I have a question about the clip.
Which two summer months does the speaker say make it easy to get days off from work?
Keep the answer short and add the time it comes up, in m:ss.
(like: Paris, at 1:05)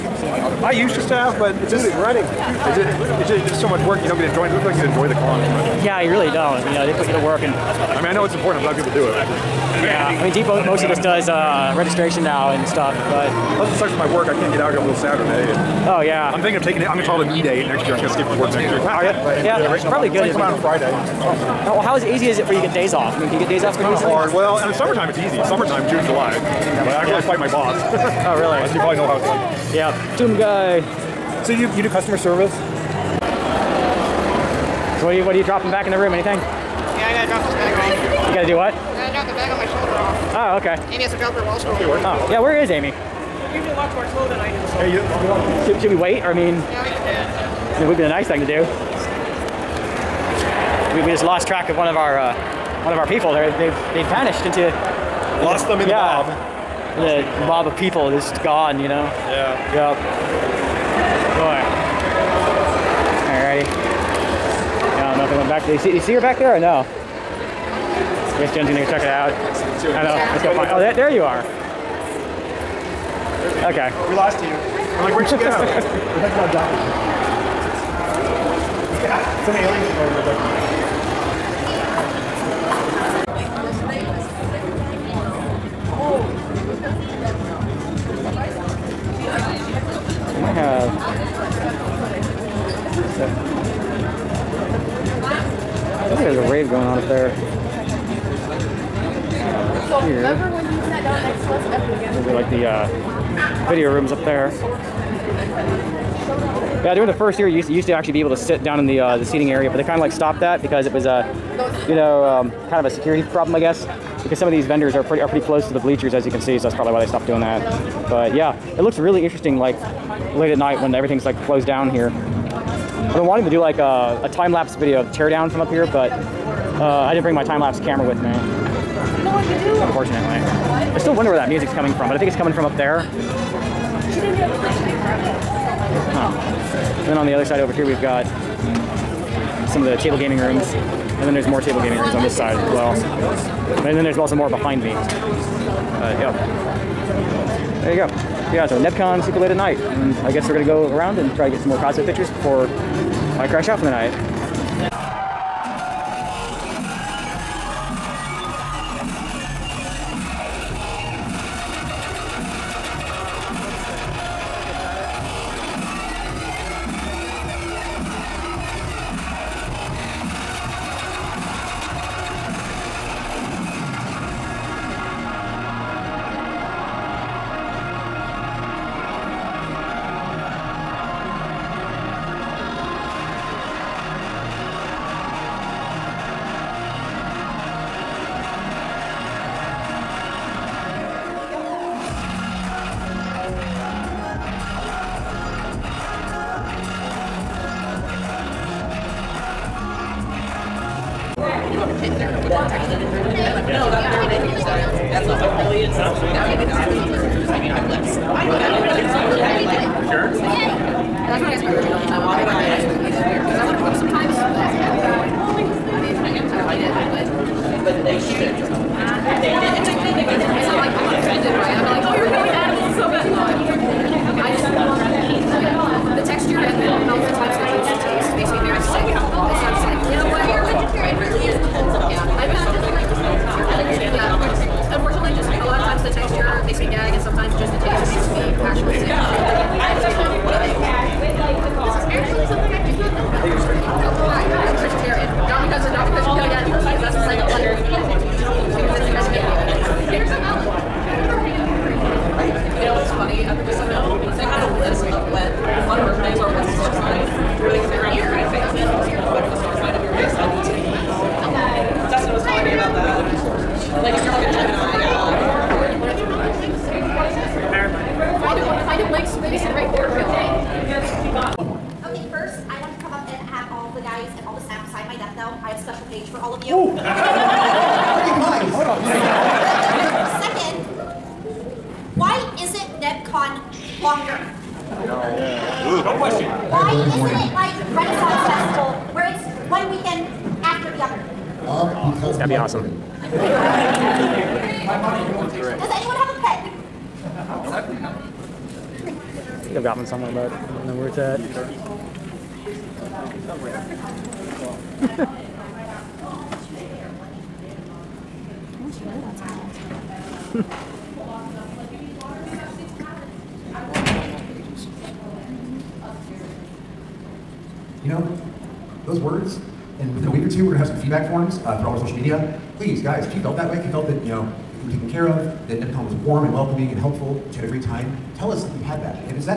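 June, July, at 0:25.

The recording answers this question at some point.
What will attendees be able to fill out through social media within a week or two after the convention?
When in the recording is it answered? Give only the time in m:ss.
5:21.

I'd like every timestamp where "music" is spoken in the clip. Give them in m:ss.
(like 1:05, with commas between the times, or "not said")
2:11.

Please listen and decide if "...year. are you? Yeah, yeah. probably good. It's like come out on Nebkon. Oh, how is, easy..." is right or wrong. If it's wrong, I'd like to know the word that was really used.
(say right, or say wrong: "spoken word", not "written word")
wrong: "Friday", not "Nebkon".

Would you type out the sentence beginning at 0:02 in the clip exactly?
It's just, it's just so much work.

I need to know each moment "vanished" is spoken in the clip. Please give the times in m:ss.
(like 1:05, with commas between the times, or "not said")
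0:54.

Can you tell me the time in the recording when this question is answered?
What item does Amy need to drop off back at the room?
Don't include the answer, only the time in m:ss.
0:41.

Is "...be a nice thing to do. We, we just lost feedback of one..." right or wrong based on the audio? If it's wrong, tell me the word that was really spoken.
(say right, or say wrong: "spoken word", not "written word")
wrong: "track", not "feedback".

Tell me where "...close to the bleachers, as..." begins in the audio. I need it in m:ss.
1:55.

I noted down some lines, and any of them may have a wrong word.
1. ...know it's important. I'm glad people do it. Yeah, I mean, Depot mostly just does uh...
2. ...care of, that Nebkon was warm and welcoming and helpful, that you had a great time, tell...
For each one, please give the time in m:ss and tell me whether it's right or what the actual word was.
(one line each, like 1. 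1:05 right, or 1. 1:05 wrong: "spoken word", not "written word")
1. 0:08 right
2. 5:25 right.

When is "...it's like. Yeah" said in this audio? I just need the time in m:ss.
0:29.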